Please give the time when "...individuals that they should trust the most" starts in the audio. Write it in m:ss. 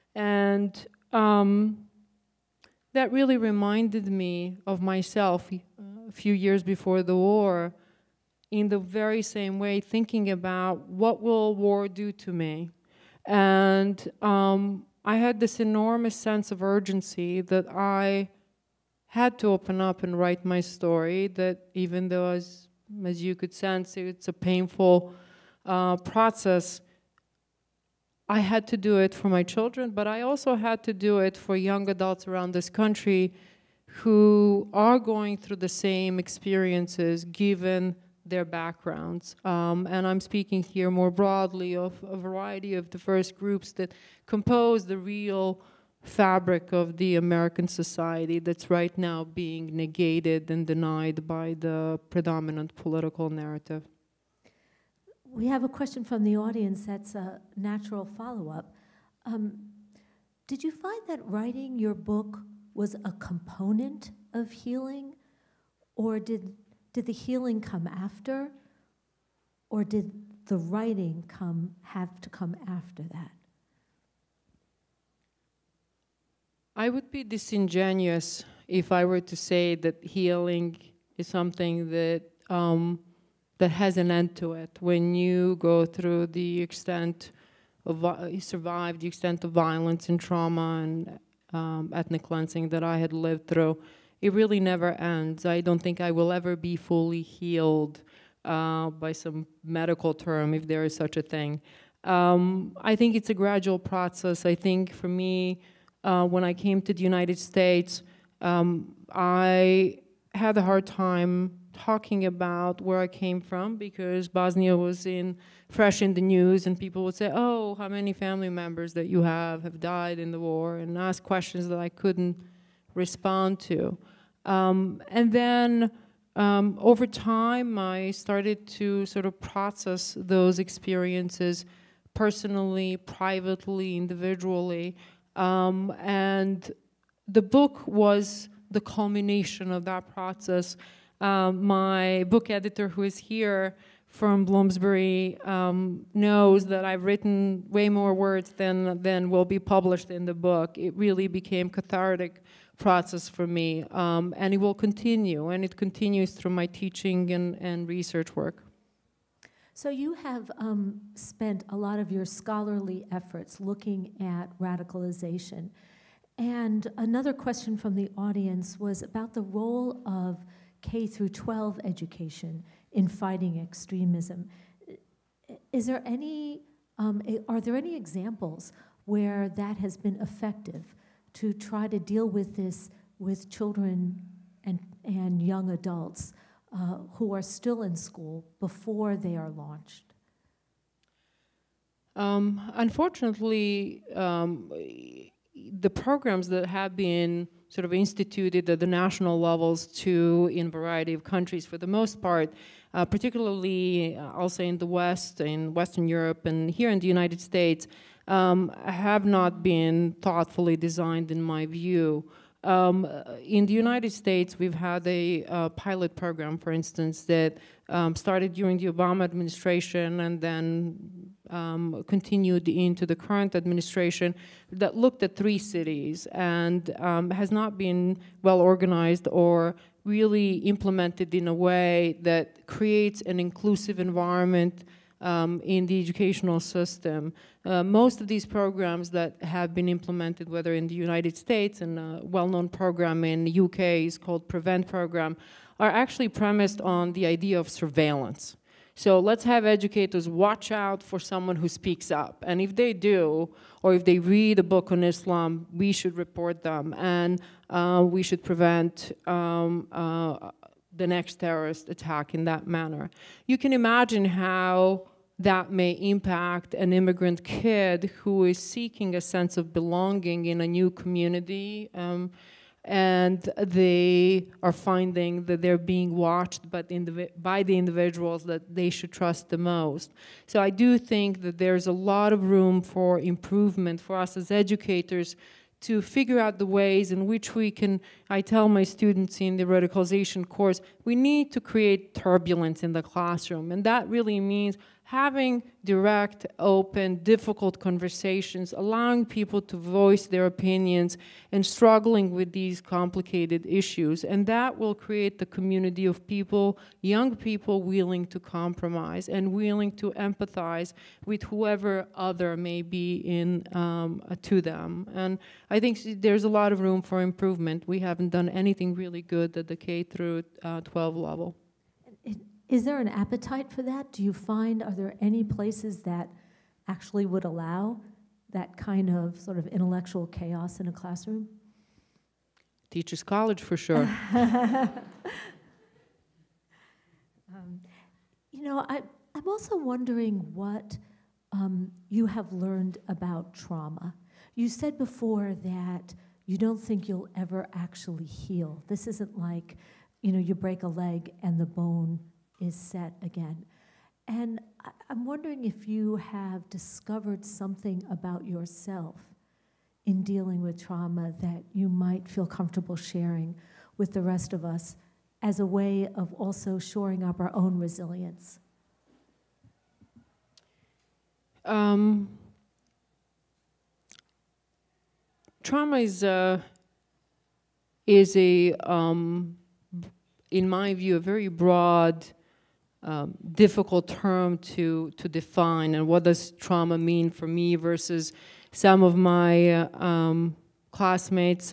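4:37.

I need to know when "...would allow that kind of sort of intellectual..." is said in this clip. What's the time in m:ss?
5:27.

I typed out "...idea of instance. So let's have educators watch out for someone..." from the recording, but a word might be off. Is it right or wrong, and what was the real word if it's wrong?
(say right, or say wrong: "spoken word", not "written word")
wrong: "surveillance", not "instance".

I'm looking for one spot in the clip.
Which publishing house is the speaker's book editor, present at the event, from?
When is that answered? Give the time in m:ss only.
2:24.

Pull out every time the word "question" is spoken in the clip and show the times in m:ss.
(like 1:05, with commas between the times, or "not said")
0:55, 2:01, 2:47.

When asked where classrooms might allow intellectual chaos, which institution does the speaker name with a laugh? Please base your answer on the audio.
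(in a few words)
Teachers College.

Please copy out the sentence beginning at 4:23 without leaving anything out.
You can imagine how that may impact an immigrant kid who is seeking a sense of belonging in a new community.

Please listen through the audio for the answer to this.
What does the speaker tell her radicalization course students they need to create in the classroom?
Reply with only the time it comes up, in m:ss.
4:52.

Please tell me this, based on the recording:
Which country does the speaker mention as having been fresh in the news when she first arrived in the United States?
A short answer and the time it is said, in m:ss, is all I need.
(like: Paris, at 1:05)
Bosnia, at 1:54.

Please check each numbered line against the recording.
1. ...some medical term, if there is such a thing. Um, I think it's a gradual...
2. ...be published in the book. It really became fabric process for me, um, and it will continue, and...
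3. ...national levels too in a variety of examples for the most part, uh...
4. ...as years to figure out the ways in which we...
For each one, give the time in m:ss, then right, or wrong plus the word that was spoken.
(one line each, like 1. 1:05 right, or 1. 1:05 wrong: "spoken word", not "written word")
1. 1:39 right
2. 2:29 wrong: "cathartic", not "fabric"
3. 3:18 wrong: "countries", not "examples"
4. 4:44 wrong: "educators", not "years".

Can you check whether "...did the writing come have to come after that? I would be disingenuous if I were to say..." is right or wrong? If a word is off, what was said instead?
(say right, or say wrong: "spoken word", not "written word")
right.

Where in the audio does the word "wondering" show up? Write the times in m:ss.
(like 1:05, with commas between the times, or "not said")
5:39, 5:55.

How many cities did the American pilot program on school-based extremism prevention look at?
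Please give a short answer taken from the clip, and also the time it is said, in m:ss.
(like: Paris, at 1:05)
3, at 3:45.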